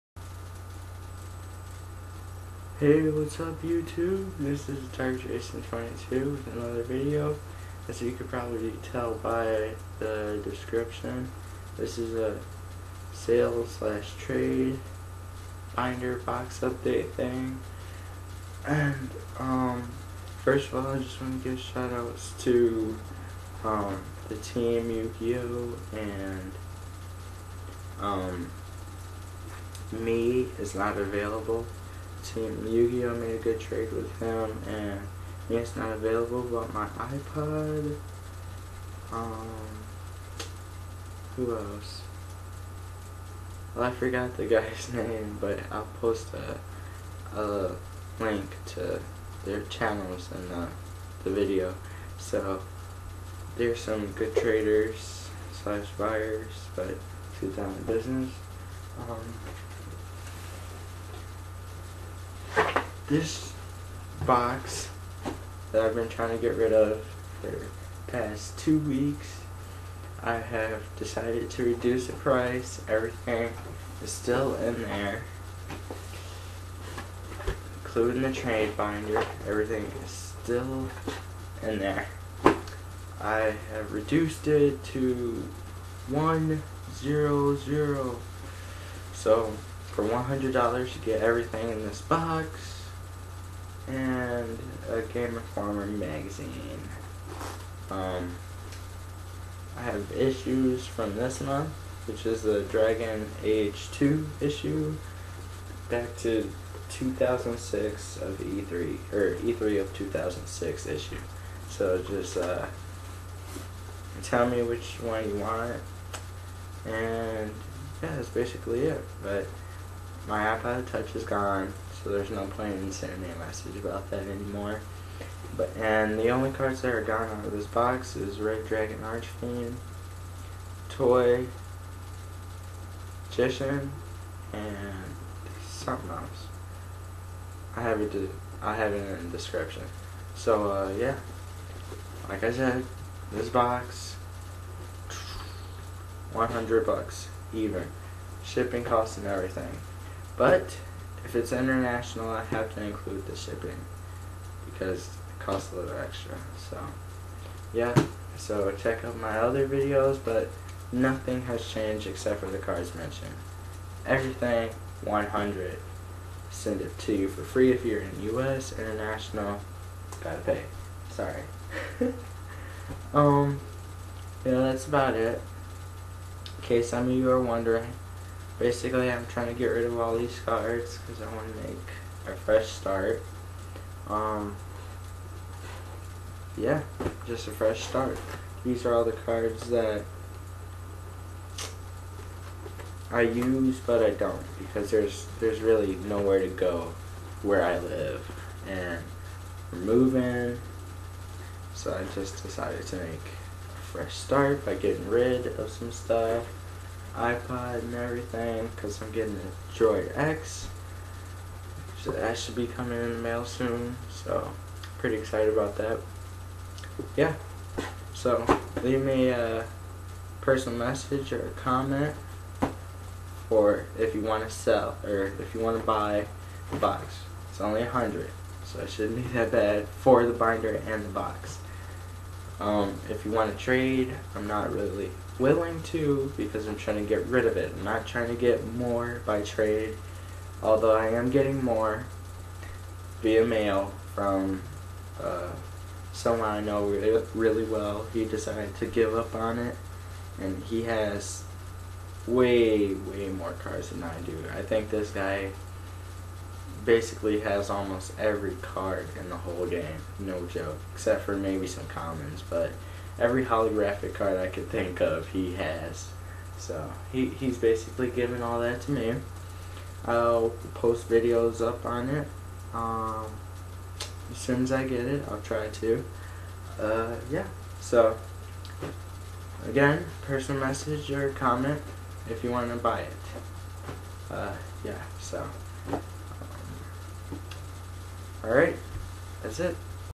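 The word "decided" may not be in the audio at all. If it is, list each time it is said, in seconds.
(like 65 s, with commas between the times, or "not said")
70 s, 202 s, 248 s.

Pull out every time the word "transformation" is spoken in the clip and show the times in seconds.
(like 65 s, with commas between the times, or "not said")
not said.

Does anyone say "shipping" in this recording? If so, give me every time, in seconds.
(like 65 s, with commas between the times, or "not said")
148 s, 153 s.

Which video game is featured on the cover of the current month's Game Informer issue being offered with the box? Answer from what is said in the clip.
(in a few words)
Dragon Age 2.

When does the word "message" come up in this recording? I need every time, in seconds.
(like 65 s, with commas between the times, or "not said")
123 s, 220 s, 280 s.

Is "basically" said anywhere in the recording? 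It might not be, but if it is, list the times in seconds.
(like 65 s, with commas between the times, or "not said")
118 s, 178 s, 256 s, 267 s.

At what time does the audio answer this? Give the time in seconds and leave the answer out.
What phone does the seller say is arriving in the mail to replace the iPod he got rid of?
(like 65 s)
209 s.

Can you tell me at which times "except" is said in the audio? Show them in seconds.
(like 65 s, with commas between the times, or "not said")
162 s, 260 s.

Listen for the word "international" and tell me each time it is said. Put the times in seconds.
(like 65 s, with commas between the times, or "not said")
151 s, 168 s.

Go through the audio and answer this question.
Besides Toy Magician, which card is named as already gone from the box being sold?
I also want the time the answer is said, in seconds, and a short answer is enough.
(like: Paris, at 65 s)
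Red Dragon Archfiend, at 128 s.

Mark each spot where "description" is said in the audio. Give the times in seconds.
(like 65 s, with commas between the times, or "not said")
10 s, 139 s.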